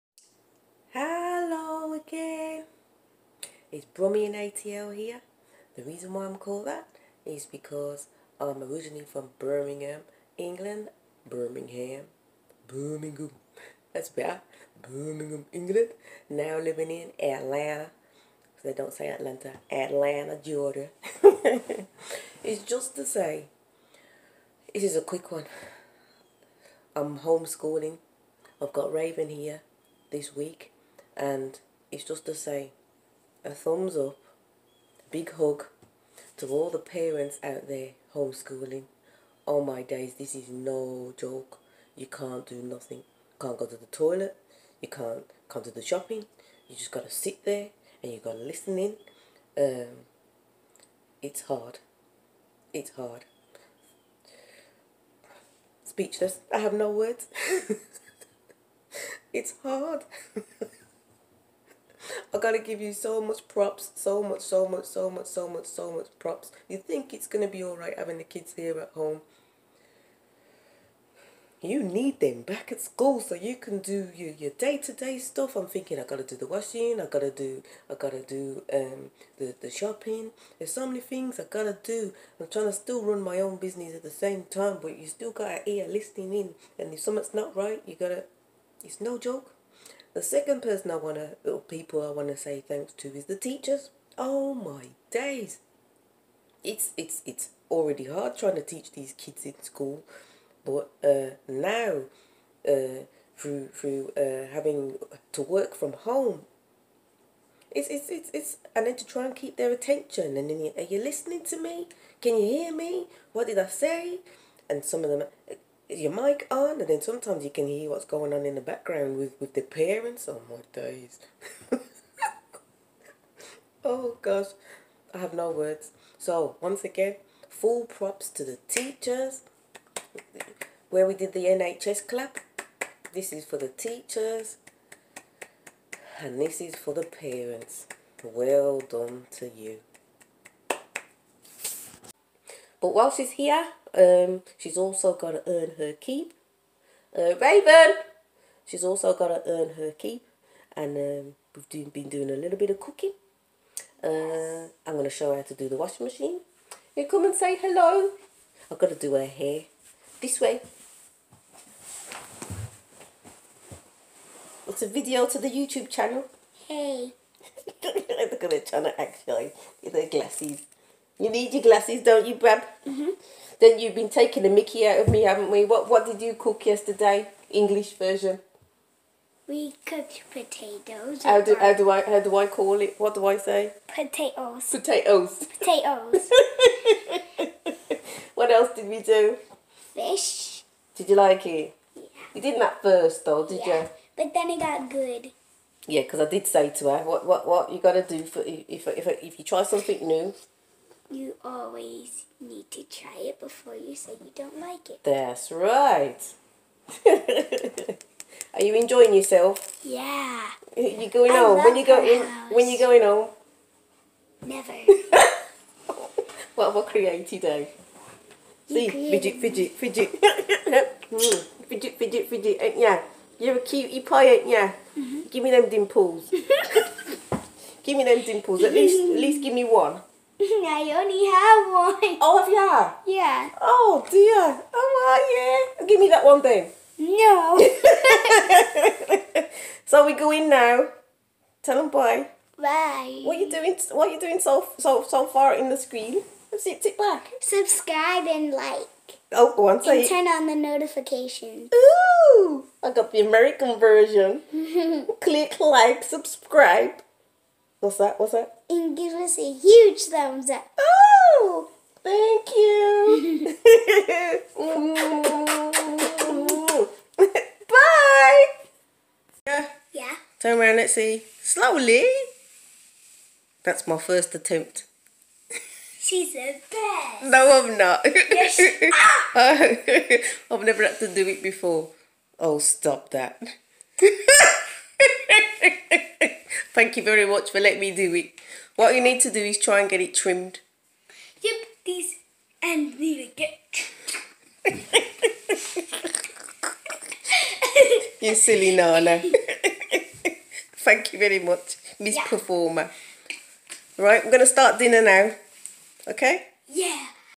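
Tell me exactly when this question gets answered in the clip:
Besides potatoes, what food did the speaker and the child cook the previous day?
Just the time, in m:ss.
3:09.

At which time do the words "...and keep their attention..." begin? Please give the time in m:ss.
1:49.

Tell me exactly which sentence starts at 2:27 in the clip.
Uh, Raven, she's also got to earn her keep.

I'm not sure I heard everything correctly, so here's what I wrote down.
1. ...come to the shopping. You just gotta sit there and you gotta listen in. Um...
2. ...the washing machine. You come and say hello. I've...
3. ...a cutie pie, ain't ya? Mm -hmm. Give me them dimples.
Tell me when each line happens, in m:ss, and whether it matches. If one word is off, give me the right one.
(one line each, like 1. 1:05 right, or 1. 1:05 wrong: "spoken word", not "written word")
1. 0:45 right
2. 2:35 right
3. 3:43 right.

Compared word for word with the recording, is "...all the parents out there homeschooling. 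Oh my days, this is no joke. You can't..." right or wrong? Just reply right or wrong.
right.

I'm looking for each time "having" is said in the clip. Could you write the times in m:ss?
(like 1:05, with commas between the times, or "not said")
1:07, 1:44.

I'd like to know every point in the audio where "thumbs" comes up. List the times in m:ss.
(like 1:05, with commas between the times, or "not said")
0:33, 4:20.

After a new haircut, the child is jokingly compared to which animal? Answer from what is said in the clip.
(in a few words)
A bear.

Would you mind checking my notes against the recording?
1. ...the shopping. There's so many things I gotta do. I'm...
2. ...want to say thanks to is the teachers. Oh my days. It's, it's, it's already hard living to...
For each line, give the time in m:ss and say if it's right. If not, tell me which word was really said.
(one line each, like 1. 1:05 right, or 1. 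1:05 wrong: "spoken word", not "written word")
1. 1:19 right
2. 1:32 wrong: "trying", not "living".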